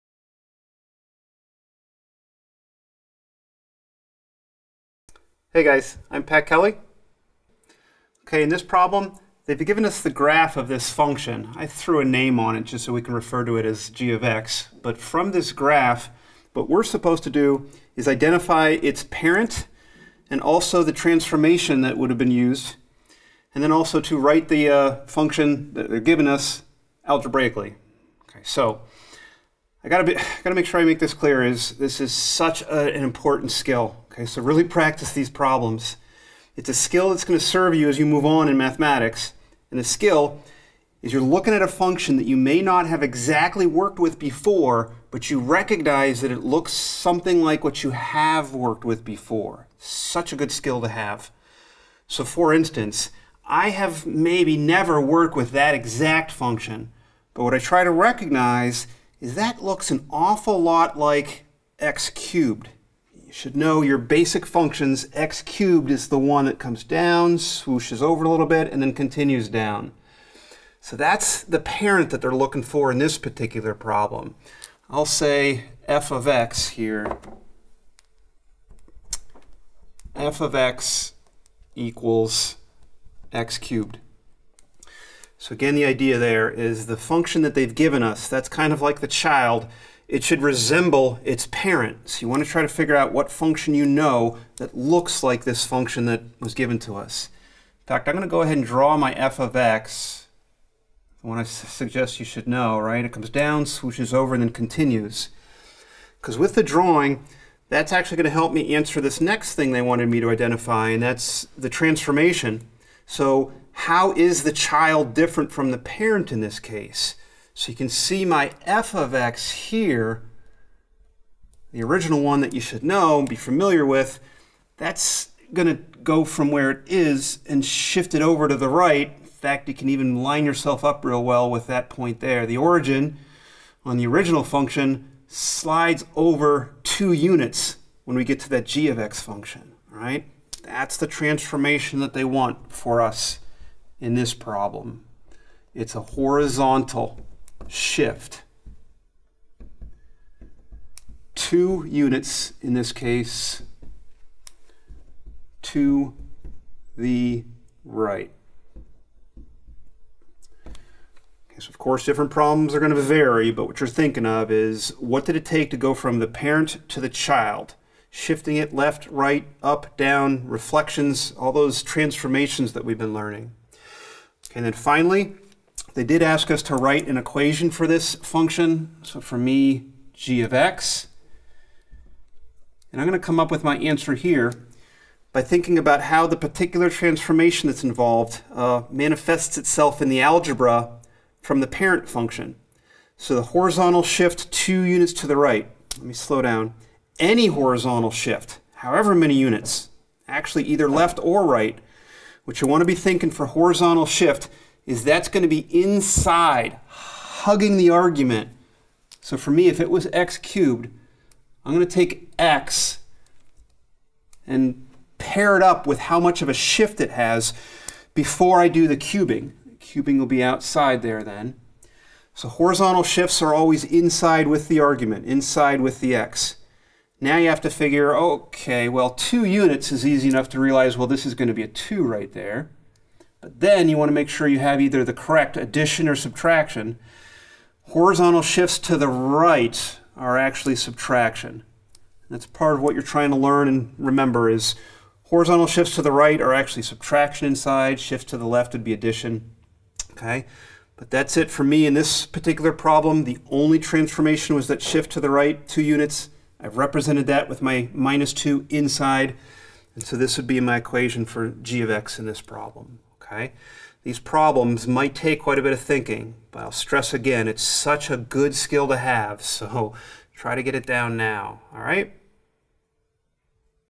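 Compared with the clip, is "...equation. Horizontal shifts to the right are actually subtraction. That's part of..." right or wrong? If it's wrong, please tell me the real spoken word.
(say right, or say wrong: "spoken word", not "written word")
wrong: "subtraction", not "equation".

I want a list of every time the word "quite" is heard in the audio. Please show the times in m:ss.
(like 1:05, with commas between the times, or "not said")
4:25.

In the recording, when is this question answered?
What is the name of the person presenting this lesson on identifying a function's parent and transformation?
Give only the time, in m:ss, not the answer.
0:06.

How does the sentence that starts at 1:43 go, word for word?
It comes down, swooshes over, and then continues.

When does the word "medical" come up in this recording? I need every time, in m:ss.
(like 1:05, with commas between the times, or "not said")
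not said.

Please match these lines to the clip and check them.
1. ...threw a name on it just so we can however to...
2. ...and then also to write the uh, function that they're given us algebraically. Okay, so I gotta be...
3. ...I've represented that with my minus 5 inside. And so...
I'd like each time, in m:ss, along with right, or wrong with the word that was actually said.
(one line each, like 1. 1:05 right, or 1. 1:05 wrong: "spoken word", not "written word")
1. 0:11 wrong: "refer", not "however"
2. 0:23 right
3. 4:16 wrong: "2", not "5".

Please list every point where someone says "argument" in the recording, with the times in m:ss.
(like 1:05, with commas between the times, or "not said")
3:27, 3:44.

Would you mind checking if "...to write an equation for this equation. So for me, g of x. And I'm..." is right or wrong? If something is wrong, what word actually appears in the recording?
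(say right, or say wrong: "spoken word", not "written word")
wrong: "function", not "equation".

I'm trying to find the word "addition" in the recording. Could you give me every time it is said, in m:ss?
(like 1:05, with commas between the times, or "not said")
3:55, 4:08.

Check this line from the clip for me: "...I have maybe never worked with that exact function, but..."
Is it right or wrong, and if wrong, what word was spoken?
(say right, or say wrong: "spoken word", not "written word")
right.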